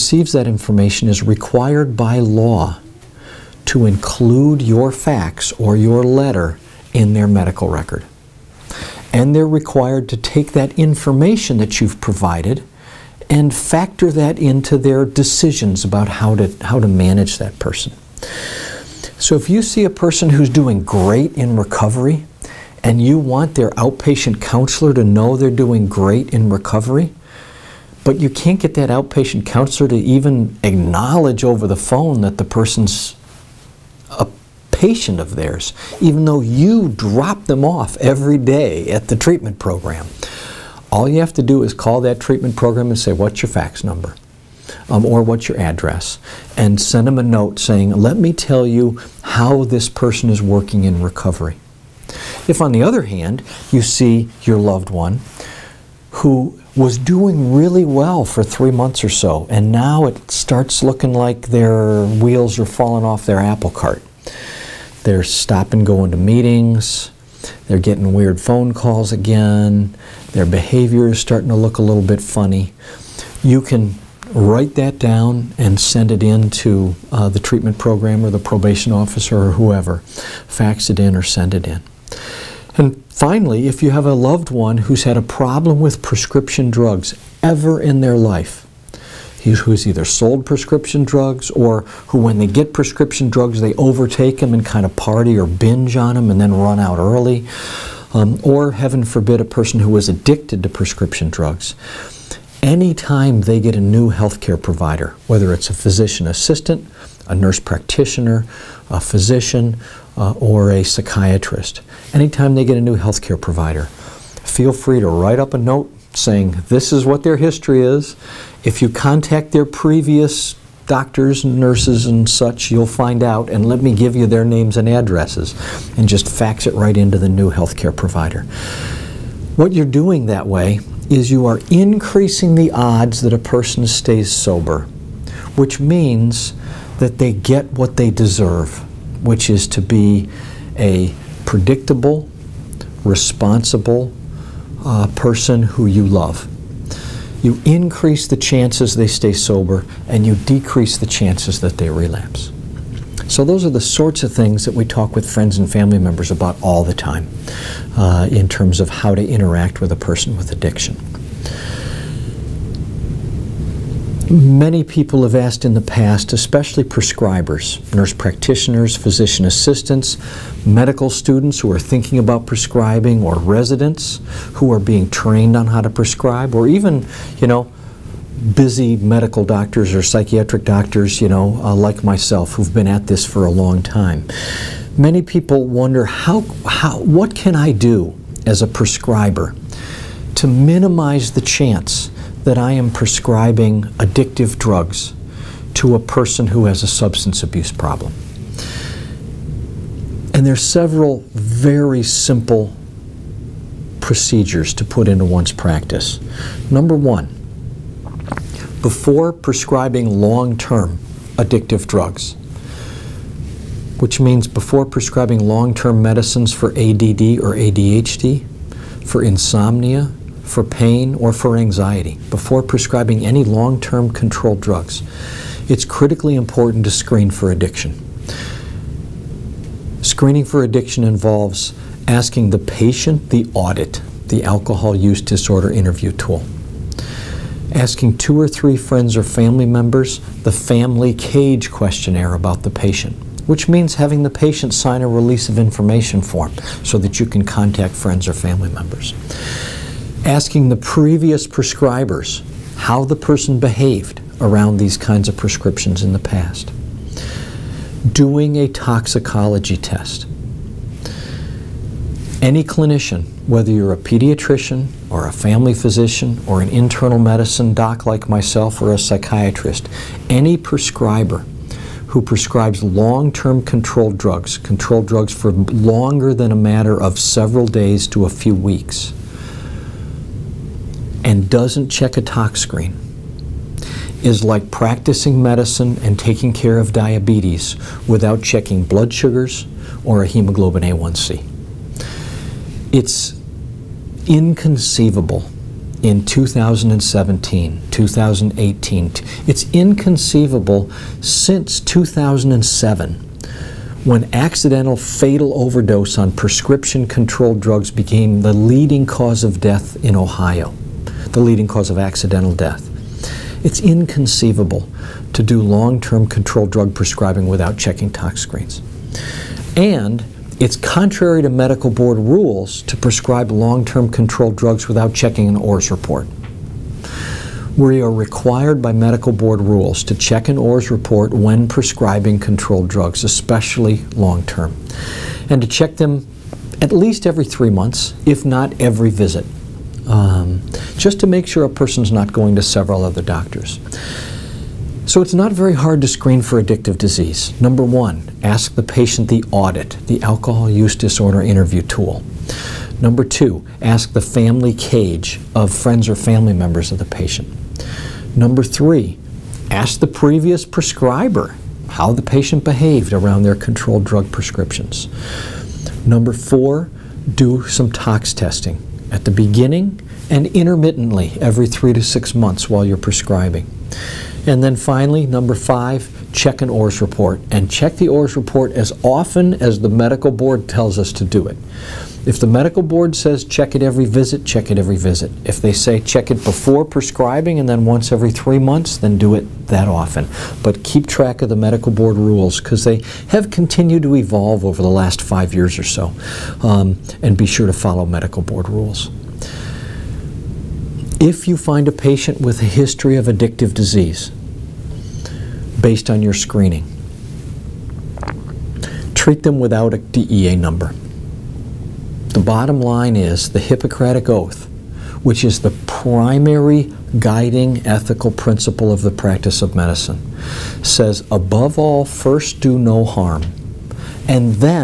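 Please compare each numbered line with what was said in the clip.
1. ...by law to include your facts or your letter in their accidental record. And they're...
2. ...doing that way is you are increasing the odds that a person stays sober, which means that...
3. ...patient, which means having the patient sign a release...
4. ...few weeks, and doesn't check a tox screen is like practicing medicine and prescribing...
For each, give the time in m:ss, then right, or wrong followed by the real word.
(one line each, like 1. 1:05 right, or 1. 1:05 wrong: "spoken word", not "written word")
1. 0:01 wrong: "medical", not "accidental"
2. 2:09 right
3. 4:02 right
4. 4:38 wrong: "taking", not "prescribing".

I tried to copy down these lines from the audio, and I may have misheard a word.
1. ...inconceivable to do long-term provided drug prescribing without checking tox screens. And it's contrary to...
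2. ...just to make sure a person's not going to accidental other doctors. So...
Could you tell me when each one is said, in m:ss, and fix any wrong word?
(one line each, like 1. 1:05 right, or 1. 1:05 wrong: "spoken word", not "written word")
1. 5:13 wrong: "controlled", not "provided"
2. 5:40 wrong: "several", not "accidental".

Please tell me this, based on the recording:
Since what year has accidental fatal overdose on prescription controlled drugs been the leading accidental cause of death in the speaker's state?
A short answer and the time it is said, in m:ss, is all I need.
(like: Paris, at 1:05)
2007, at 5:01.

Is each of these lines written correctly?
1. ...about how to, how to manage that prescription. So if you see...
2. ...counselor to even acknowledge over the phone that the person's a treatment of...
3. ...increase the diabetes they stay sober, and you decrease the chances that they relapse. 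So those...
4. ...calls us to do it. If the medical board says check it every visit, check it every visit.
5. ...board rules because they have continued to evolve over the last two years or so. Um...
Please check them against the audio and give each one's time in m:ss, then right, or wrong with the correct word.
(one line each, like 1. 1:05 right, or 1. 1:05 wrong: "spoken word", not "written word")
1. 0:15 wrong: "person", not "prescription"
2. 0:29 wrong: "patient", not "treatment"
3. 2:27 wrong: "chances", not "diabetes"
4. 6:20 wrong: "tells", not "calls"
5. 6:31 wrong: "five", not "two".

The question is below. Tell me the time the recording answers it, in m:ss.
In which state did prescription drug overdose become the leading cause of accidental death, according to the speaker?
5:10.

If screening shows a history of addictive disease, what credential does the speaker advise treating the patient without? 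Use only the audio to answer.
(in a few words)
a DEA number.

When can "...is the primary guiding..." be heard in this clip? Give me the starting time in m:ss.
6:55.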